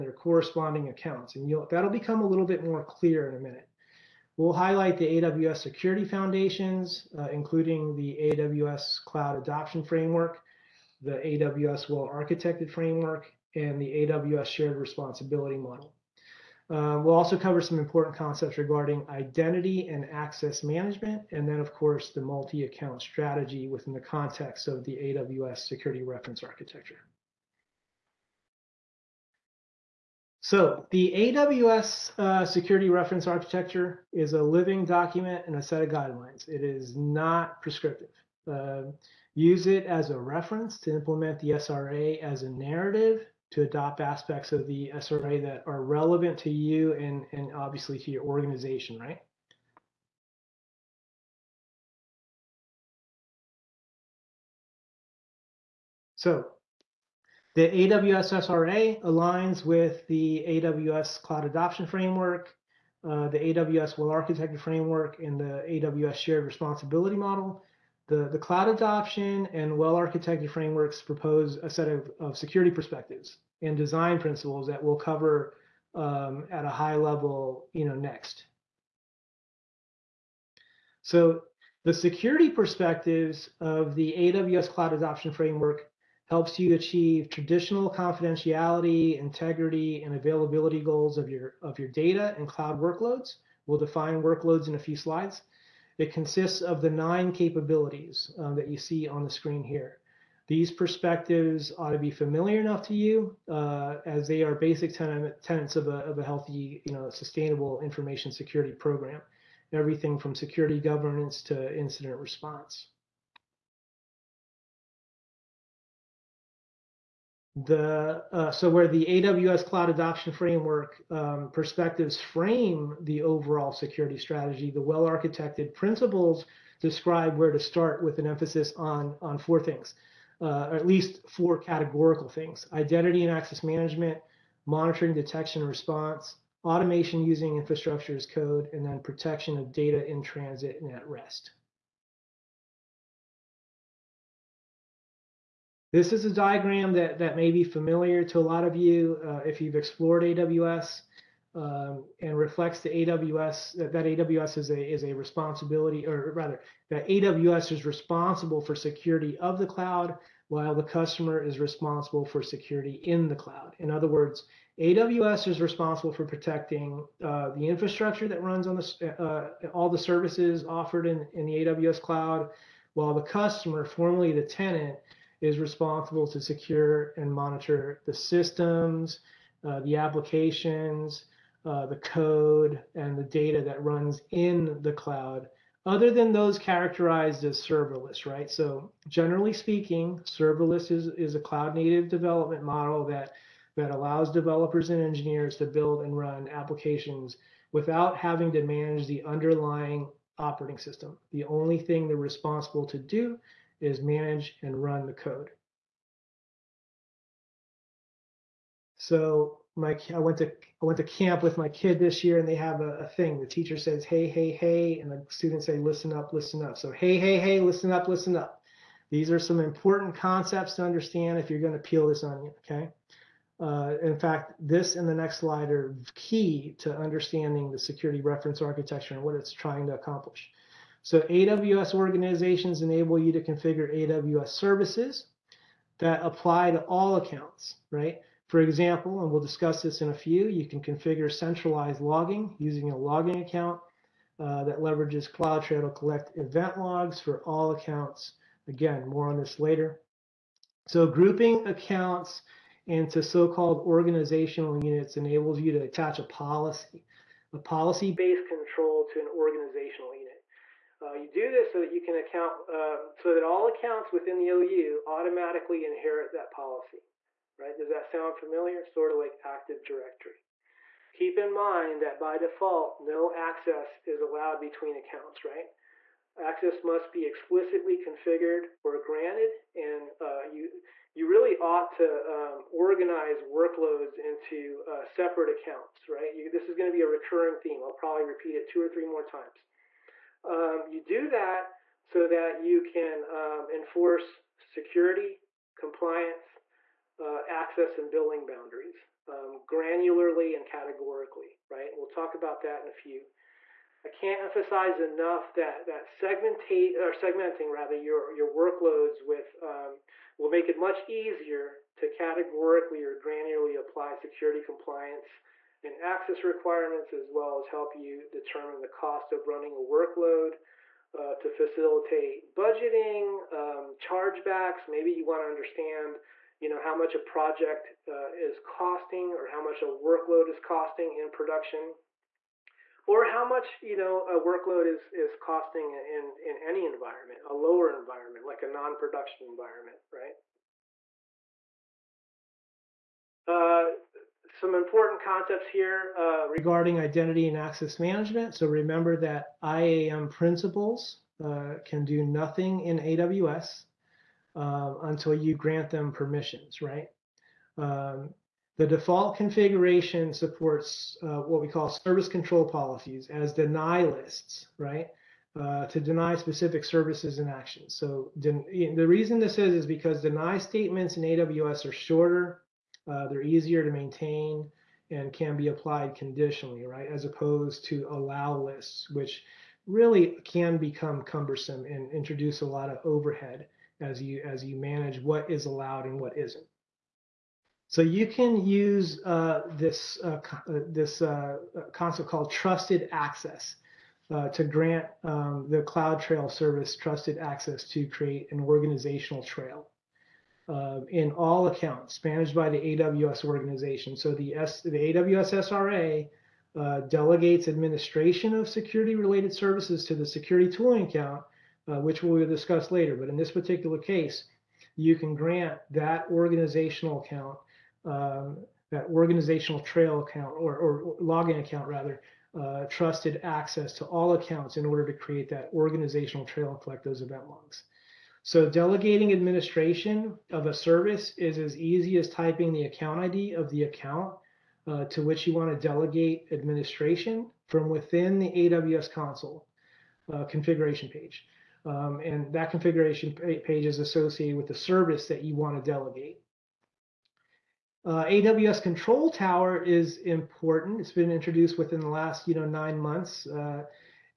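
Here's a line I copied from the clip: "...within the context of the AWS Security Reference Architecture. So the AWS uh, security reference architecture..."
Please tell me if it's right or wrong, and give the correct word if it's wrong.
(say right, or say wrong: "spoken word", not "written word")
right.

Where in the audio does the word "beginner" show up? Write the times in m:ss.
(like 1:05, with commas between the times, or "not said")
not said.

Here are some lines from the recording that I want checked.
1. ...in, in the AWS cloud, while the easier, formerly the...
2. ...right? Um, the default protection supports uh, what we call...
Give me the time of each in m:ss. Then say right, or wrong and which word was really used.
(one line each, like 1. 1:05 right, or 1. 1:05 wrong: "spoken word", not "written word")
1. 2:51 wrong: "customer", not "easier"
2. 5:56 wrong: "configuration", not "protection".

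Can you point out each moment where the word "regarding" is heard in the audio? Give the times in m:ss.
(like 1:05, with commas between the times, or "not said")
0:18, 5:46.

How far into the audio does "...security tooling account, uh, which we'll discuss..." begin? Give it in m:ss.
6:50.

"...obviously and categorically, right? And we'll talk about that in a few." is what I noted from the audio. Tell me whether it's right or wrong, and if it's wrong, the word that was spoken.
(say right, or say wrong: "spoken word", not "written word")
wrong: "granularly", not "obviously".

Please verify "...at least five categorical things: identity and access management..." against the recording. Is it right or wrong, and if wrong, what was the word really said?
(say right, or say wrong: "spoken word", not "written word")
wrong: "four", not "five".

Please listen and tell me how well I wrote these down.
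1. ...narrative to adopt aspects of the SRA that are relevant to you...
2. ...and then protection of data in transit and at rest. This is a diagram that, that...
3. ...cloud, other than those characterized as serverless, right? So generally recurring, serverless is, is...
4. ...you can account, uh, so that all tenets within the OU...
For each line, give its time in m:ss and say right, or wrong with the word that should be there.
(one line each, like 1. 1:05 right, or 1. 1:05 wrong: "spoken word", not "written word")
1. 0:42 right
2. 2:18 right
3. 3:04 wrong: "speaking", not "recurring"
4. 4:21 wrong: "accounts", not "tenets".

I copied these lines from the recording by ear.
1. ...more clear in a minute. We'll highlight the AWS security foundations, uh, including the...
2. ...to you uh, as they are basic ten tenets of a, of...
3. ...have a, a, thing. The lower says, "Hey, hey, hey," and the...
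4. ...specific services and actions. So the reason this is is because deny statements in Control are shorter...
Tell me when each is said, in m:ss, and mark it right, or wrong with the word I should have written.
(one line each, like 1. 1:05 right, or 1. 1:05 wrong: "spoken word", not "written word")
1. 0:02 right
2. 1:42 right
3. 3:32 wrong: "teacher", not "lower"
4. 6:06 wrong: "AWS", not "Control".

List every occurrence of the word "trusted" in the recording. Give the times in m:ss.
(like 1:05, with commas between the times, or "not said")
6:32, 6:36, 7:02.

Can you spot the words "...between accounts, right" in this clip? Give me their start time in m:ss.
4:34.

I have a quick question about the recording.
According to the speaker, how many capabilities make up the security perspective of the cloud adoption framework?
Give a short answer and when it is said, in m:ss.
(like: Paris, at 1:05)
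9, at 1:36.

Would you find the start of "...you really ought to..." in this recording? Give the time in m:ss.
4:41.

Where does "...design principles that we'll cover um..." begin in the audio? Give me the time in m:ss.
1:13.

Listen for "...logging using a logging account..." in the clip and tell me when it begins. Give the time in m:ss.
4:01.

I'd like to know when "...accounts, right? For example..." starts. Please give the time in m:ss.
3:57.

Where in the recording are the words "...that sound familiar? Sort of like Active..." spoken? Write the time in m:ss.
4:27.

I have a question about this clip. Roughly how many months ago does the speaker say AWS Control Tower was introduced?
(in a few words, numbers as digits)
9 months.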